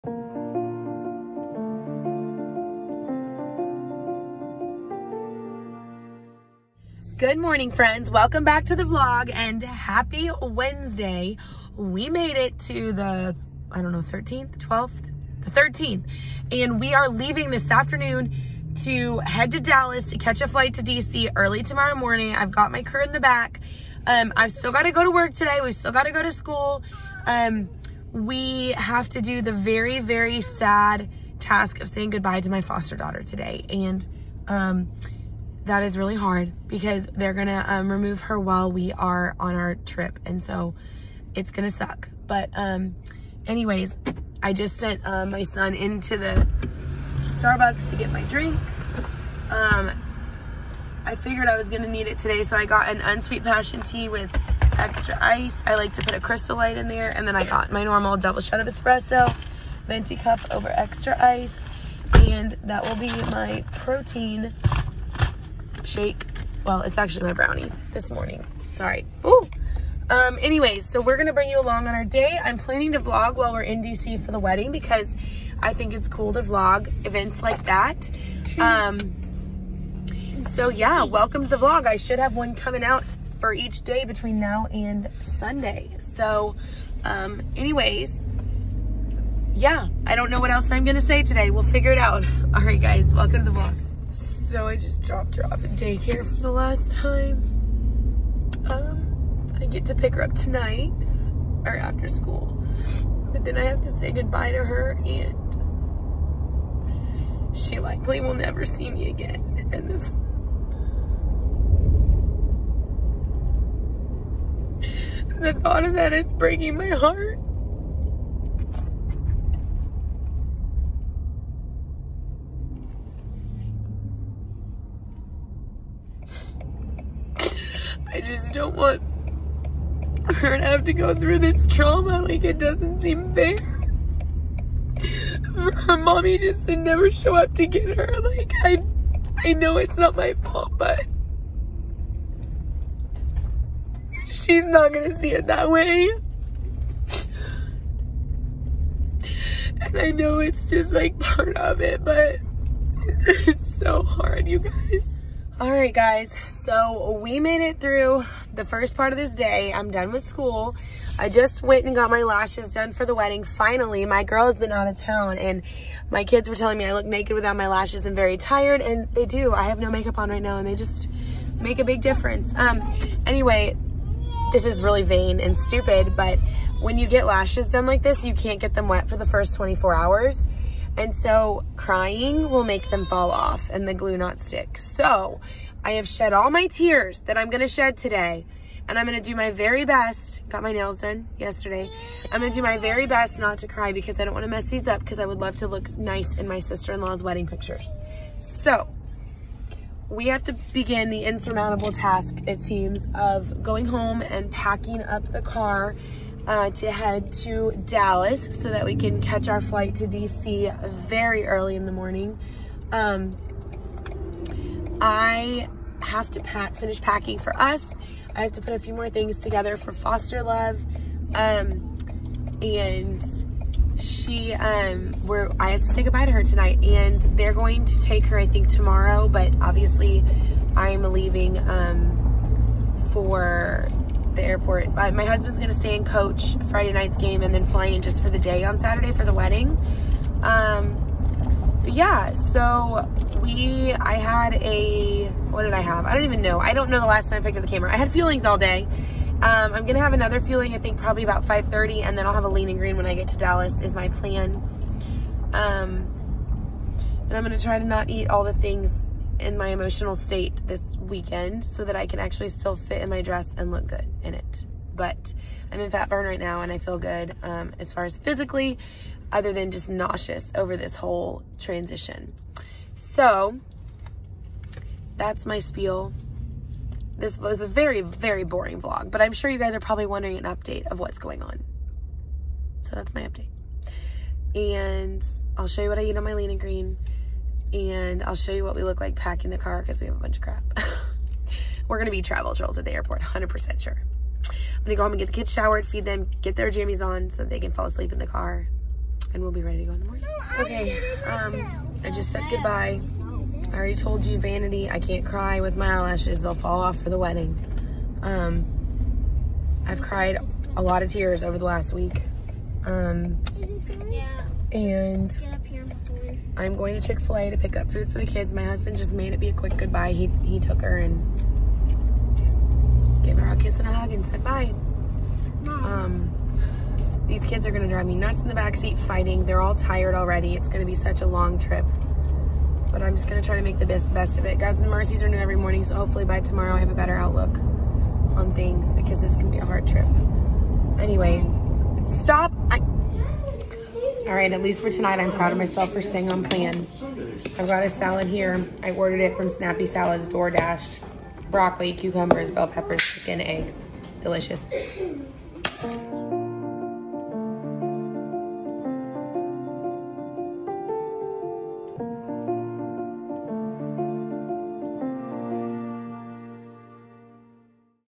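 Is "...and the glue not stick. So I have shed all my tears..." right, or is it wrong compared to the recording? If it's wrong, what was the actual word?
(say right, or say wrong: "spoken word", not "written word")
right.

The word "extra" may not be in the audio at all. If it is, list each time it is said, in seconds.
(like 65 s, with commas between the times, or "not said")
54 s, 60 s.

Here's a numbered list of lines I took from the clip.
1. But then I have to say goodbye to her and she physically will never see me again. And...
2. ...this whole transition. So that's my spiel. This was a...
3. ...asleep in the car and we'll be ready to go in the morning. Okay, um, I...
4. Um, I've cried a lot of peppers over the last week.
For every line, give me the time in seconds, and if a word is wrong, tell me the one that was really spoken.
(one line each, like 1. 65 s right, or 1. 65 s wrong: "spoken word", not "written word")
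1. 103 s wrong: "likely", not "physically"
2. 270 s right
3. 297 s right
4. 308 s wrong: "tears", not "peppers".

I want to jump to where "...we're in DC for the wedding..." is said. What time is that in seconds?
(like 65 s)
73 s.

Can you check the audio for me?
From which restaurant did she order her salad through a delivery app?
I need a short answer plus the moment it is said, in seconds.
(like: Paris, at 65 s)
Snappy Salads, at 349 s.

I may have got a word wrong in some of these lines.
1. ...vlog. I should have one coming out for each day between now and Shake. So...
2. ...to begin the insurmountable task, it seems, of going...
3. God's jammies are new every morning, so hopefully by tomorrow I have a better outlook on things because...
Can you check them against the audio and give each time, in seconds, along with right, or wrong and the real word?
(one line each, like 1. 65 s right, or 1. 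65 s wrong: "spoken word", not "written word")
1. 81 s wrong: "Sunday", not "Shake"
2. 200 s right
3. 334 s wrong: "mercies", not "jammies".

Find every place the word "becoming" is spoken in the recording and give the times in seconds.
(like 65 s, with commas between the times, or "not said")
not said.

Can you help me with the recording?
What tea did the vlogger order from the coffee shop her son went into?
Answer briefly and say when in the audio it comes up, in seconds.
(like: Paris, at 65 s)
Unsweet passion tea, at 53 s.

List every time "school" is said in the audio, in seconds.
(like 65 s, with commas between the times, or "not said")
26 s, 102 s, 160 s.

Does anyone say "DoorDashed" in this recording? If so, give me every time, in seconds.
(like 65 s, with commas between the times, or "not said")
350 s.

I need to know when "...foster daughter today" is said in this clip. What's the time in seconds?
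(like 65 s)
32 s.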